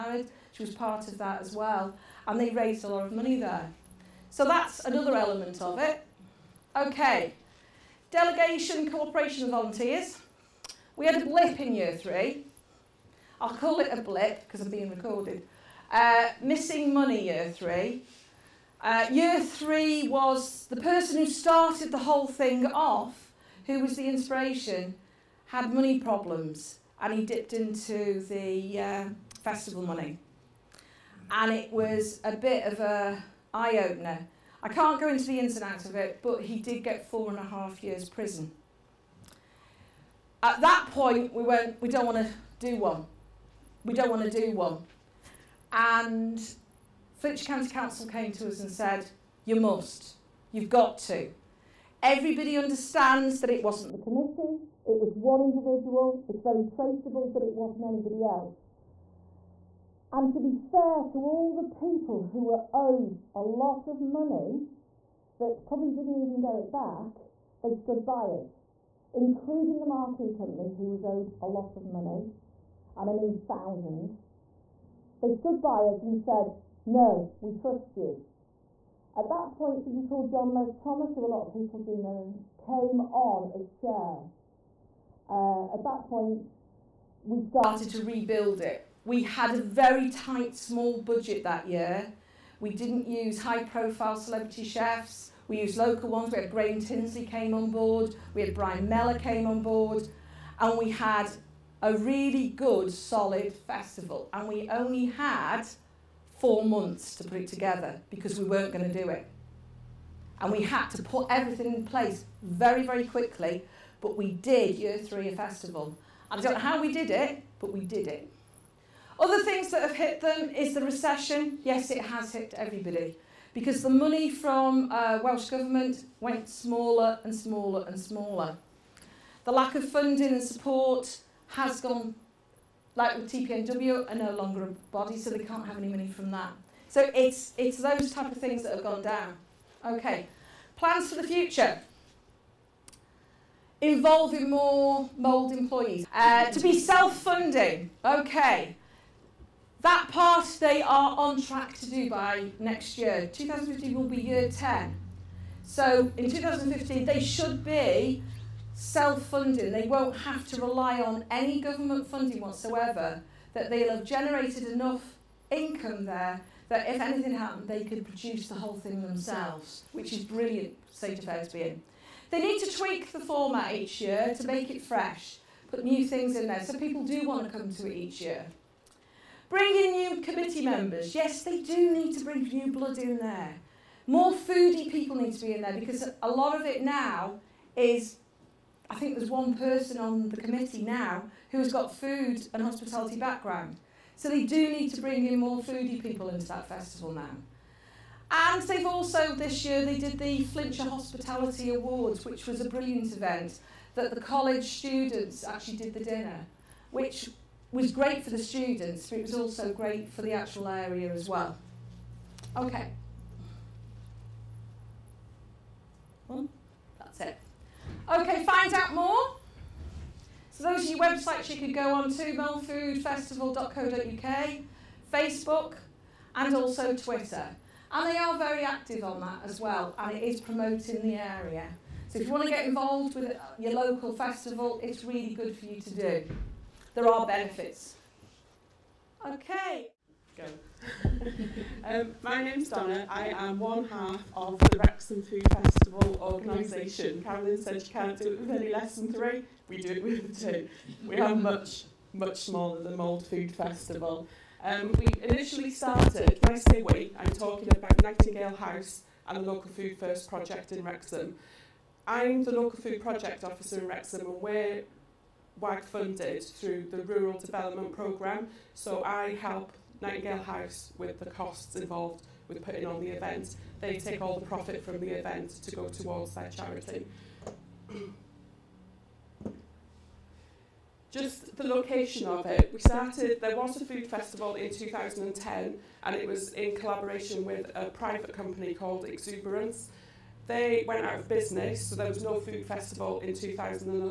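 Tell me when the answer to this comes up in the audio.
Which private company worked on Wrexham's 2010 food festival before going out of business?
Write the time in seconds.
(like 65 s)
289 s.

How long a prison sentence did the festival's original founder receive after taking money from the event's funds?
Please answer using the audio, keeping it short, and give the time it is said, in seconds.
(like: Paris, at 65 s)
4.5 years, at 37 s.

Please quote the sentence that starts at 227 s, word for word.
And they are very active on that as well, and it is promoting the area.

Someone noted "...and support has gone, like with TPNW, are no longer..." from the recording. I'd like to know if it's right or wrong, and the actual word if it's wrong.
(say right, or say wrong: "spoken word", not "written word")
right.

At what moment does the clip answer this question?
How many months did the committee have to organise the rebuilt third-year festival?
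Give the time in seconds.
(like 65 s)
106 s.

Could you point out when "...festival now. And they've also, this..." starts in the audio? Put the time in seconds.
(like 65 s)
196 s.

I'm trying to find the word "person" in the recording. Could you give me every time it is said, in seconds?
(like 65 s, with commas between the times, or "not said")
20 s, 189 s.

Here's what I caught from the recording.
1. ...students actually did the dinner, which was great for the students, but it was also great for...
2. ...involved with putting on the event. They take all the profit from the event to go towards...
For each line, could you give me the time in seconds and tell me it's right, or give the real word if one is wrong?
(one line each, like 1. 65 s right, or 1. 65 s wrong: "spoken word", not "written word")
1. 204 s right
2. 271 s right.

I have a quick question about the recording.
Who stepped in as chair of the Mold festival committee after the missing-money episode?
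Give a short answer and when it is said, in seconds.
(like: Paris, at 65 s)
John Les Thomas, at 80 s.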